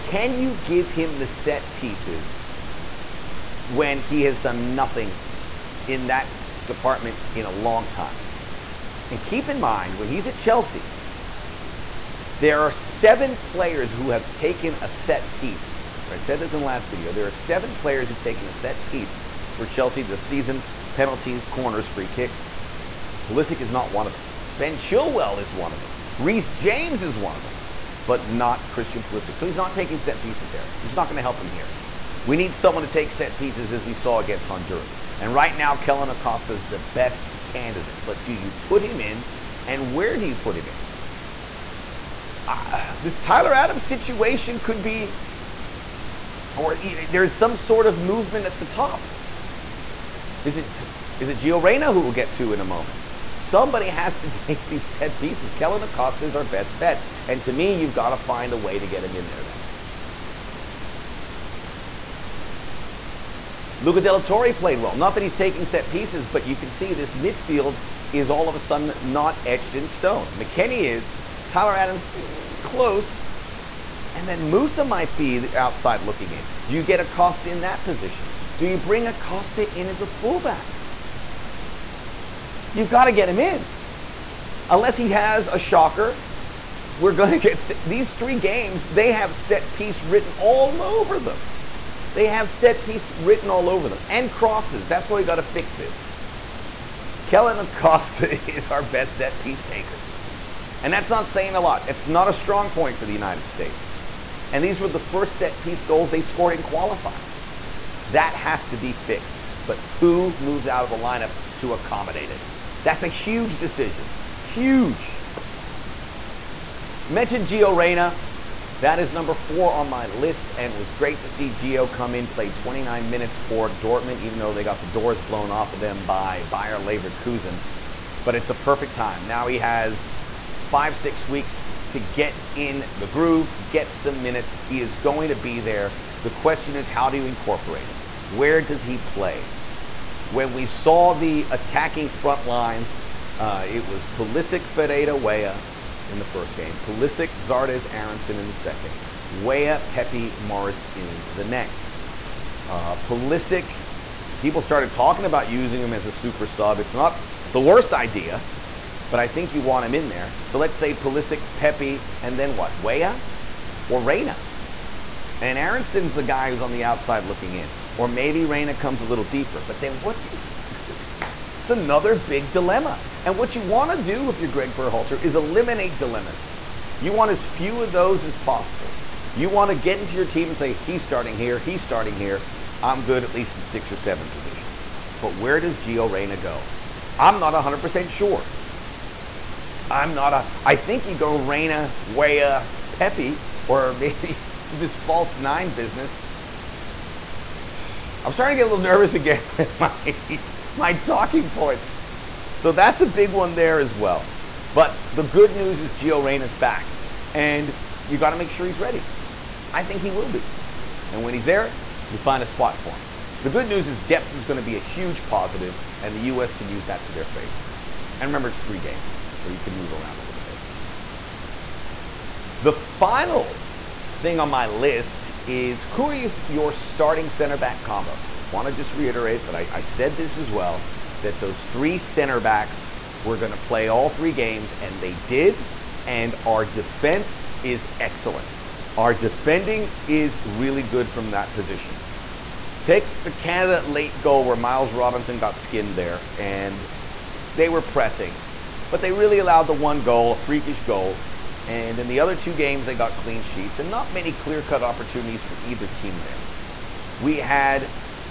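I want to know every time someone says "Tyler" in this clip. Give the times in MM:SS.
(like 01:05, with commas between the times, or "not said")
00:43, 01:11.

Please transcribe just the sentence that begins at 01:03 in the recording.
Luca de la Torre played well.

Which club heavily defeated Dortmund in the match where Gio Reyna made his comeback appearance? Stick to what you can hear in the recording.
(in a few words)
Bayer Leverkusen.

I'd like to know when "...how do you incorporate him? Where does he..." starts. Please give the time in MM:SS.
02:16.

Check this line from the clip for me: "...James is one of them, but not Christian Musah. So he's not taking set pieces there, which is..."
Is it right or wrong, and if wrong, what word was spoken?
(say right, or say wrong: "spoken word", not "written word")
wrong: "Pulisic", not "Musah".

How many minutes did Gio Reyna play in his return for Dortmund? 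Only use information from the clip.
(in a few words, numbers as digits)
29.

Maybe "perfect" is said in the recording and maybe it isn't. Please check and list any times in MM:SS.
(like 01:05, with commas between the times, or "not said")
02:08.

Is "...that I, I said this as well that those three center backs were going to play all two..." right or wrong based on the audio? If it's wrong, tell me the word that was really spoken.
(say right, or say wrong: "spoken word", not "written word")
wrong: "three", not "two".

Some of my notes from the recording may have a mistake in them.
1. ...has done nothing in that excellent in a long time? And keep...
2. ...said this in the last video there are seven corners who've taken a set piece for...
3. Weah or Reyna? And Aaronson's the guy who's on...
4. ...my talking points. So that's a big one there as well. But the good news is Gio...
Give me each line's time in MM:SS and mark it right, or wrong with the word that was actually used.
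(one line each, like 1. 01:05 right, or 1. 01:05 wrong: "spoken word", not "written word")
1. 00:04 wrong: "department", not "excellent"
2. 00:16 wrong: "players", not "corners"
3. 02:42 right
4. 03:20 right.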